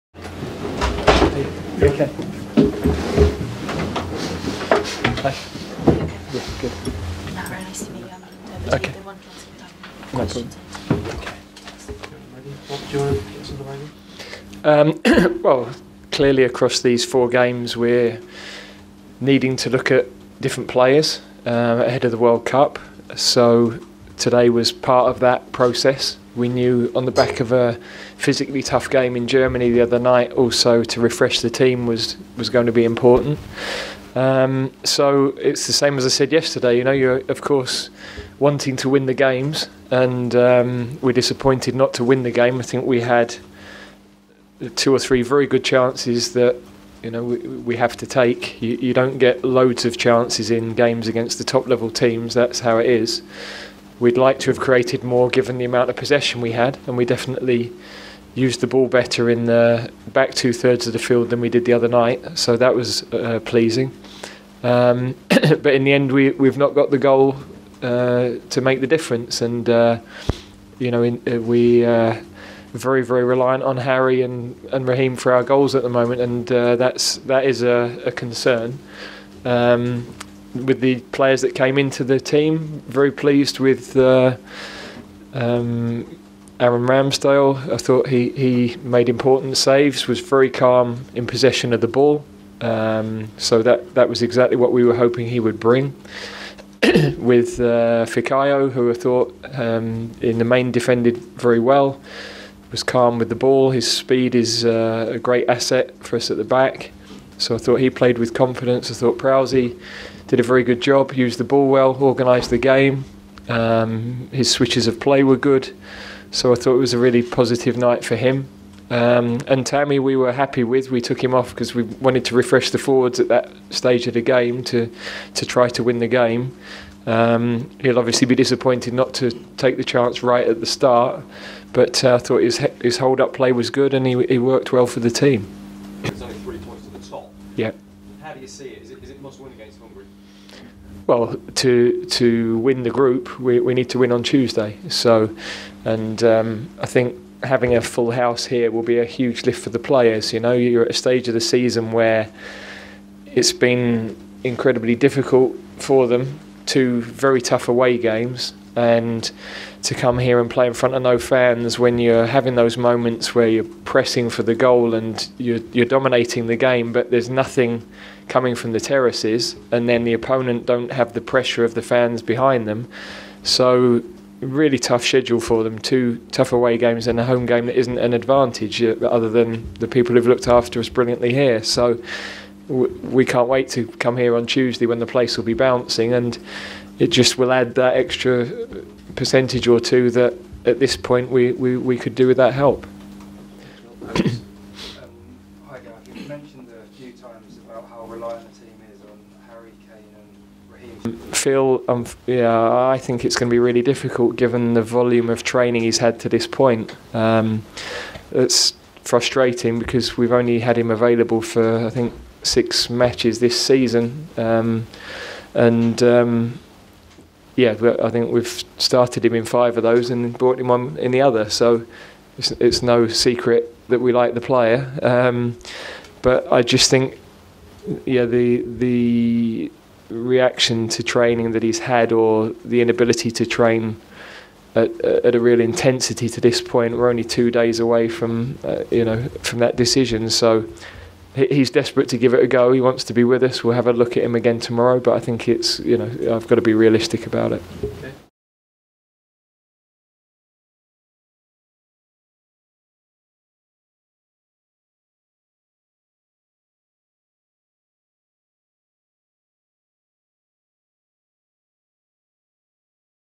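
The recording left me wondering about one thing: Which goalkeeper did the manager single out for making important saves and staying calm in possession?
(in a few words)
Aaron Ramsdale.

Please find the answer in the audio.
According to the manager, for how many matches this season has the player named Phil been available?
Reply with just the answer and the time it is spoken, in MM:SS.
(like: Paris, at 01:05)
6, at 03:32.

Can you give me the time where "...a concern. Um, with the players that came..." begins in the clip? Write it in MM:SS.
01:18.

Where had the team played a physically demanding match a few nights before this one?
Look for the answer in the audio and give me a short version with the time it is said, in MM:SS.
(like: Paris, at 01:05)
Germany, at 00:29.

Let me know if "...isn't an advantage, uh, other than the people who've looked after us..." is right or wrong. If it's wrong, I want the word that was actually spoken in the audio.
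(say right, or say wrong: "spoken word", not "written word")
right.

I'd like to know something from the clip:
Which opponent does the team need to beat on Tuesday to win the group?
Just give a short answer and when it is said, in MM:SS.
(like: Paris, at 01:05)
Hungary, at 02:19.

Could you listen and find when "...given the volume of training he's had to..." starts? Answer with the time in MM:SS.
03:24.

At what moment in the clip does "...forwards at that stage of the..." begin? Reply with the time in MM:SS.
02:02.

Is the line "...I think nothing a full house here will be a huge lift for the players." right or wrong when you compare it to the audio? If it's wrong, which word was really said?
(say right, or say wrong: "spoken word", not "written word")
wrong: "having", not "nothing".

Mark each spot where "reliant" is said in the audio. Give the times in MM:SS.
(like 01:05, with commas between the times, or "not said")
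01:13.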